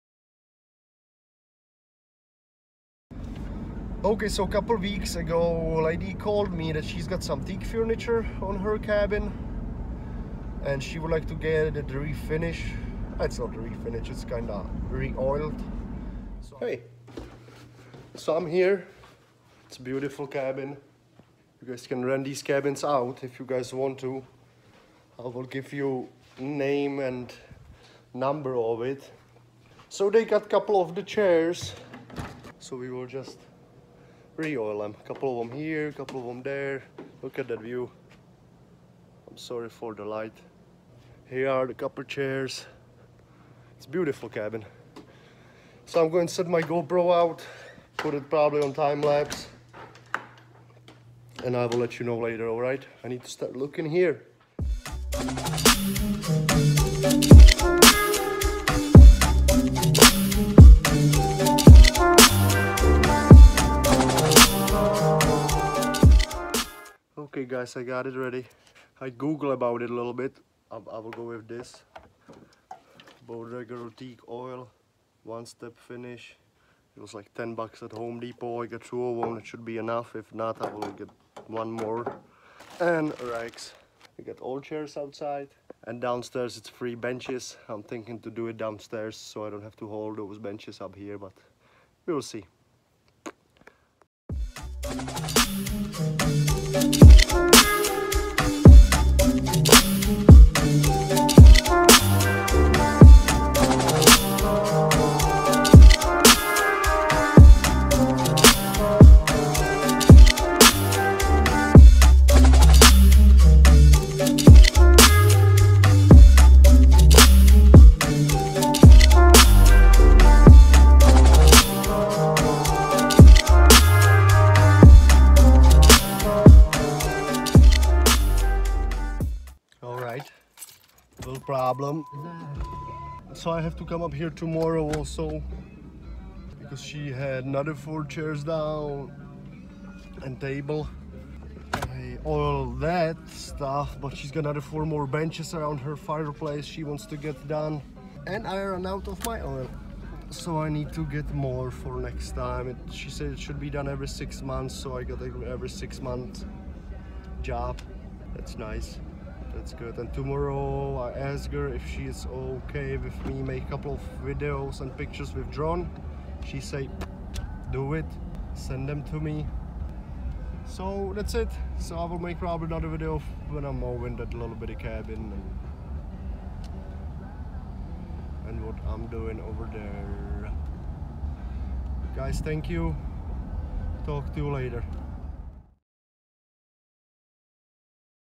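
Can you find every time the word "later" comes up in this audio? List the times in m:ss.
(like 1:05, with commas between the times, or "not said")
0:52, 3:04.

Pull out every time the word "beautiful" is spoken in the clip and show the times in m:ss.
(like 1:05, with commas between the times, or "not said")
0:19, 0:43.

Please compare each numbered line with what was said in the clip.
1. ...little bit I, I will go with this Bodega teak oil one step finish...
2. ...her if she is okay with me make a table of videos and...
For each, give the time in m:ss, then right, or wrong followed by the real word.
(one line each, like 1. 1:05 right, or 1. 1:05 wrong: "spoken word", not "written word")
1. 1:09 right
2. 2:41 wrong: "couple", not "table".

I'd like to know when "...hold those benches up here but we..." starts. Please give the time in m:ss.
1:29.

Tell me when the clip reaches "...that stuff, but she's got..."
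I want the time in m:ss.
2:22.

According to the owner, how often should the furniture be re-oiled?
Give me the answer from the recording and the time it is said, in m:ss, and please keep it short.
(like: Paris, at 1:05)
Every 6 months, at 2:33.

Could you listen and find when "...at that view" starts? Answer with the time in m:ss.
0:37.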